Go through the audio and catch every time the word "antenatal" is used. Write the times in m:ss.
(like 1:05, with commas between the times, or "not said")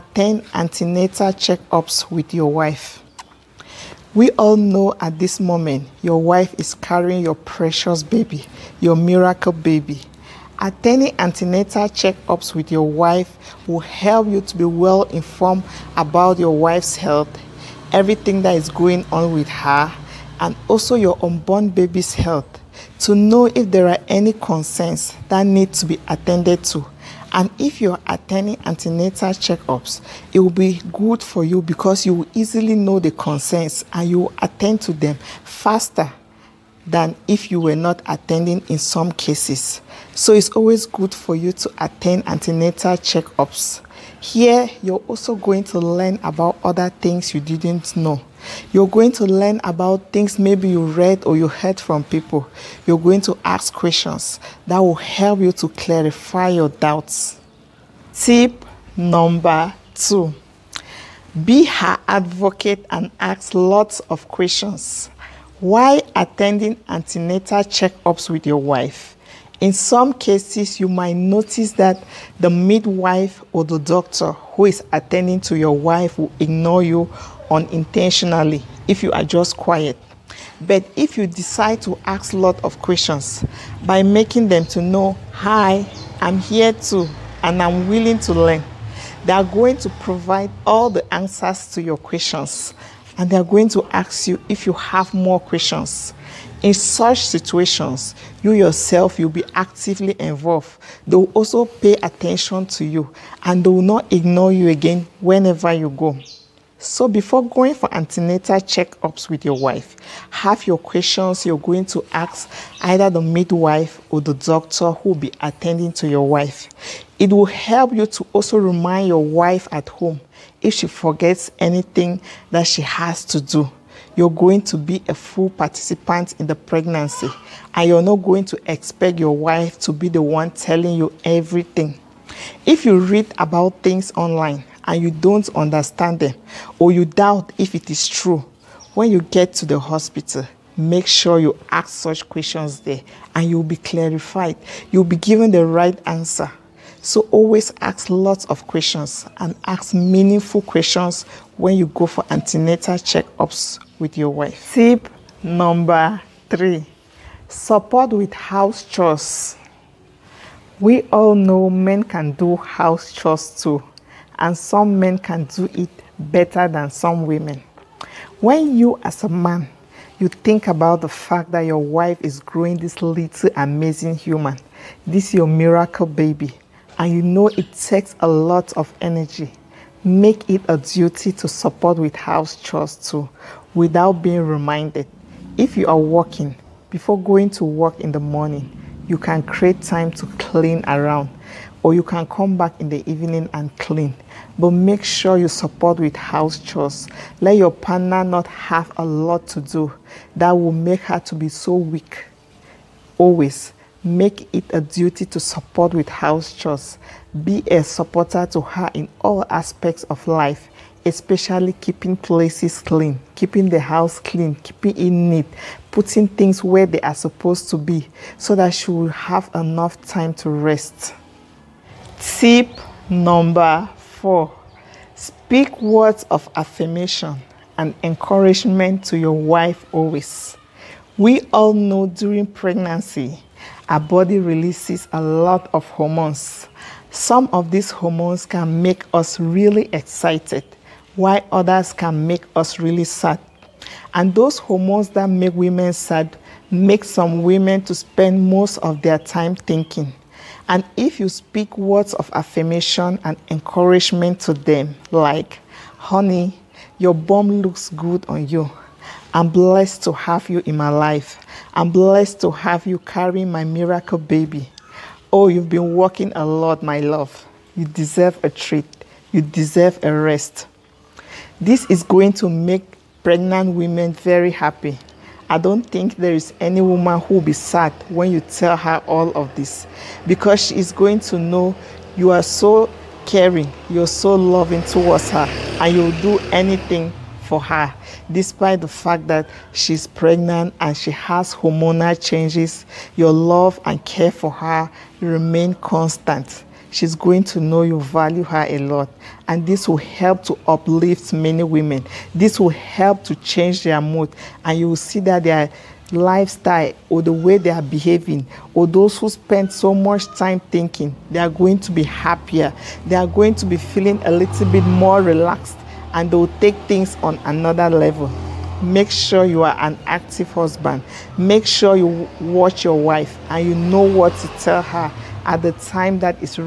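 0:00, 0:11, 0:28, 0:42, 1:06, 1:47, 2:32.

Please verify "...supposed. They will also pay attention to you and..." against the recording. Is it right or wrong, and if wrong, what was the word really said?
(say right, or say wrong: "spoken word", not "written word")
wrong: "involved", not "supposed".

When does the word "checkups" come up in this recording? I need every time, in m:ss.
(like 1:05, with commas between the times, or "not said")
0:01, 0:11, 0:29, 0:42, 1:07, 1:48, 2:32.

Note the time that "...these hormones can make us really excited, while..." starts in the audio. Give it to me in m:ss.
3:57.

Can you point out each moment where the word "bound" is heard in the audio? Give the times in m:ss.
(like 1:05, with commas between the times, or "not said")
not said.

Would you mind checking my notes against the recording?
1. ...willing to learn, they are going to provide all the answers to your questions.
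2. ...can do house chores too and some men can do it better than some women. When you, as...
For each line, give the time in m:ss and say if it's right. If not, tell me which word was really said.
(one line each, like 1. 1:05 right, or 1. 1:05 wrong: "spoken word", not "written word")
1. 1:27 right
2. 2:42 right.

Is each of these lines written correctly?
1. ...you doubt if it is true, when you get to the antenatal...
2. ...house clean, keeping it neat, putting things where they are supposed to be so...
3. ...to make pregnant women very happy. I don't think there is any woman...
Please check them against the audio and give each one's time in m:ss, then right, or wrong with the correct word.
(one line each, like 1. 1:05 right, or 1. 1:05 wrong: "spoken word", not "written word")
1. 2:16 wrong: "hospital", not "antenatal"
2. 3:33 right
3. 4:32 right.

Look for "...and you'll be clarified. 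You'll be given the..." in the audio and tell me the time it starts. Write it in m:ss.
2:23.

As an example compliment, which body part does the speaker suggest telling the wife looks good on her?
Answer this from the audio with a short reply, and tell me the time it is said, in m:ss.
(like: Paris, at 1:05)
Bum, at 4:17.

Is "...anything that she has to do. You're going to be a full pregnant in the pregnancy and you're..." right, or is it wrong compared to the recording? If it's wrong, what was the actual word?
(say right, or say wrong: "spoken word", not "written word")
wrong: "participant", not "pregnant".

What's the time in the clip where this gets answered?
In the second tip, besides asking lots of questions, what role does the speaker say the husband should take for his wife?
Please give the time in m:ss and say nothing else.
1:01.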